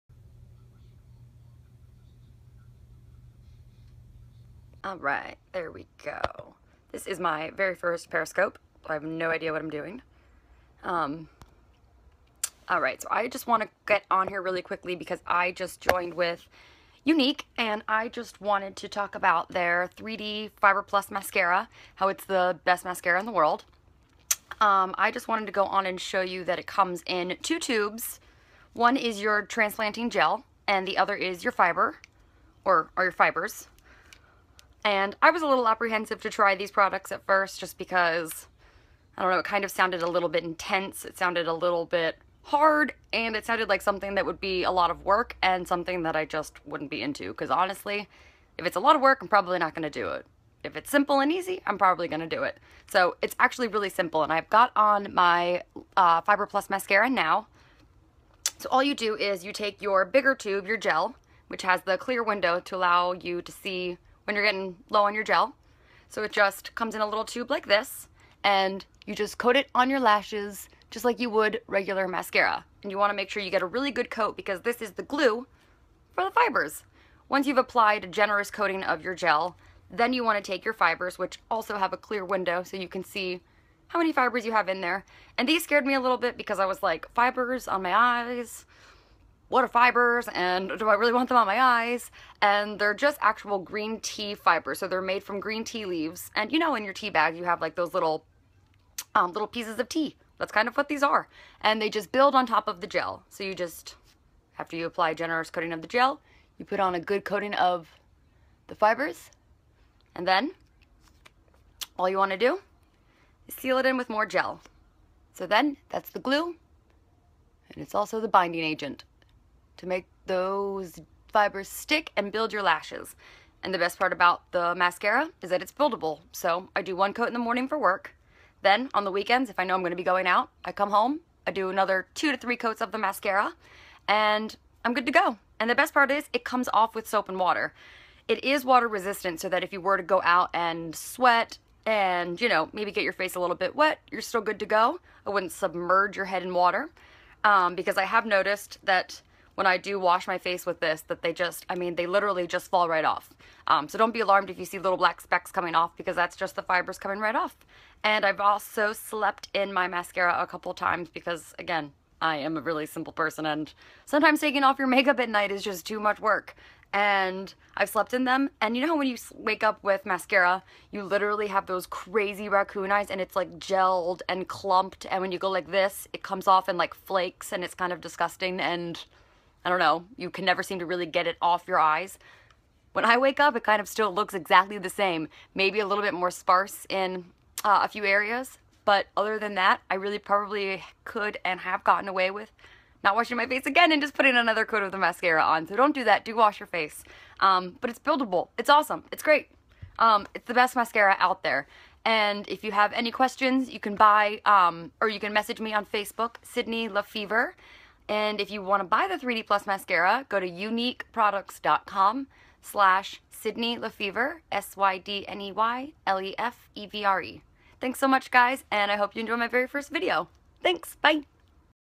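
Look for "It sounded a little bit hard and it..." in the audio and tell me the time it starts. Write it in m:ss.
0:41.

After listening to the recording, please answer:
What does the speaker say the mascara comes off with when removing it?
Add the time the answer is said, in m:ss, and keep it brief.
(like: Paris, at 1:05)
Soap and water, at 2:17.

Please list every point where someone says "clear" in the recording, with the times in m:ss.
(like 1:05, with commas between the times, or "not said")
1:01, 1:21.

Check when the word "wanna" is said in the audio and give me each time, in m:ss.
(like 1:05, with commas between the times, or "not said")
1:12, 1:20.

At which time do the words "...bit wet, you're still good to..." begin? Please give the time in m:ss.
2:23.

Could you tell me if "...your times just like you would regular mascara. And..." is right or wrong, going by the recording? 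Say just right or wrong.
wrong.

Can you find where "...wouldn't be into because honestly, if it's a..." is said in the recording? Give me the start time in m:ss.
0:46.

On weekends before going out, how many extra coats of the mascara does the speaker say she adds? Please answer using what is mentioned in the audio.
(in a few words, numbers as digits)
2 to 3.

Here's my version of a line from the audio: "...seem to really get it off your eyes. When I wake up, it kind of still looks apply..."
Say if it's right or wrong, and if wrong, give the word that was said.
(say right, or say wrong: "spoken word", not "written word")
wrong: "exactly", not "apply".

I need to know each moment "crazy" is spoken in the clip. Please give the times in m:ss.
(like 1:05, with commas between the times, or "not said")
2:51.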